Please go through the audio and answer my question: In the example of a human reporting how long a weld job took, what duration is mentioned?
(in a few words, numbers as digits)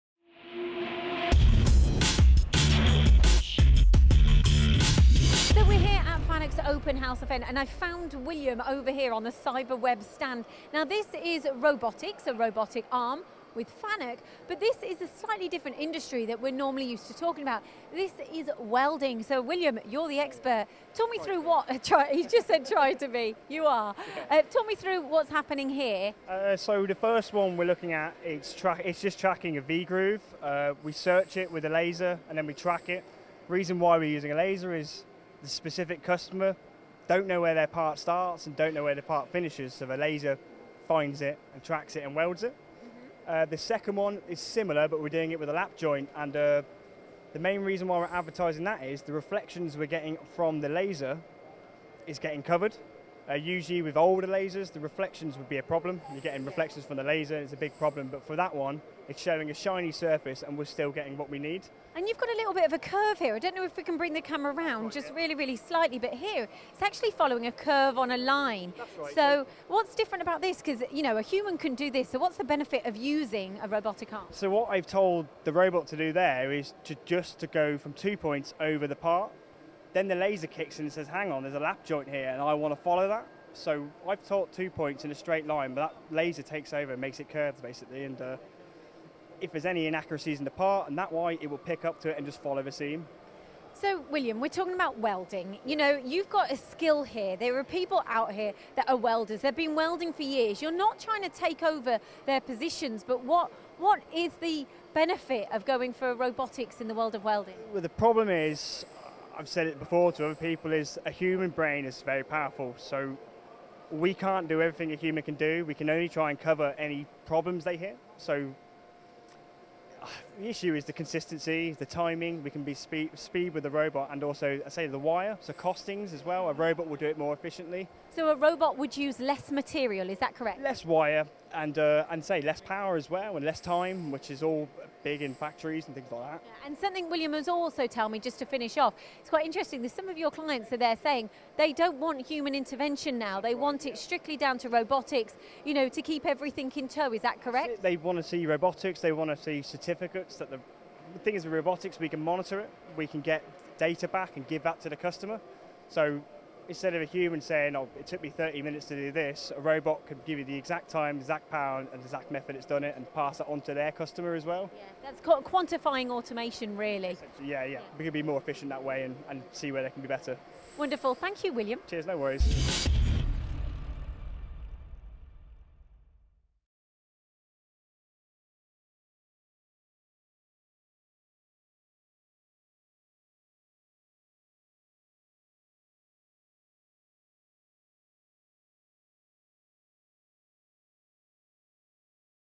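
30 minutes.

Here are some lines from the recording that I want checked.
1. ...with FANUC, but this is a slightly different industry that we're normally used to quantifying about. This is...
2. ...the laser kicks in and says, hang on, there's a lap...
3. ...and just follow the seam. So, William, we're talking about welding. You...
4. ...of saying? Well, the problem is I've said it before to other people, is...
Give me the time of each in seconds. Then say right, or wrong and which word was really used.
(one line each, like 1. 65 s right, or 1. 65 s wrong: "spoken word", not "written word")
1. 13 s wrong: "talking", not "quantifying"
2. 80 s right
3. 92 s right
4. 107 s wrong: "welding", not "saying".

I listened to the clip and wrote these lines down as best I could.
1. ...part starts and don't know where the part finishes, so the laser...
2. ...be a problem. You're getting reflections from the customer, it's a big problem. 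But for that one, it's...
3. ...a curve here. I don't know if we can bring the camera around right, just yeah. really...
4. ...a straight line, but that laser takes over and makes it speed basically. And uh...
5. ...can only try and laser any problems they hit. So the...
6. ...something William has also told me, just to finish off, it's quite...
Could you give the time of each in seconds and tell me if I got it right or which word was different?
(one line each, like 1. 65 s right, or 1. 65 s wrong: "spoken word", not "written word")
1. 37 s right
2. 55 s wrong: "laser", not "customer"
3. 62 s right
4. 85 s wrong: "curved", not "speed"
5. 115 s wrong: "cover", not "laser"
6. 136 s right.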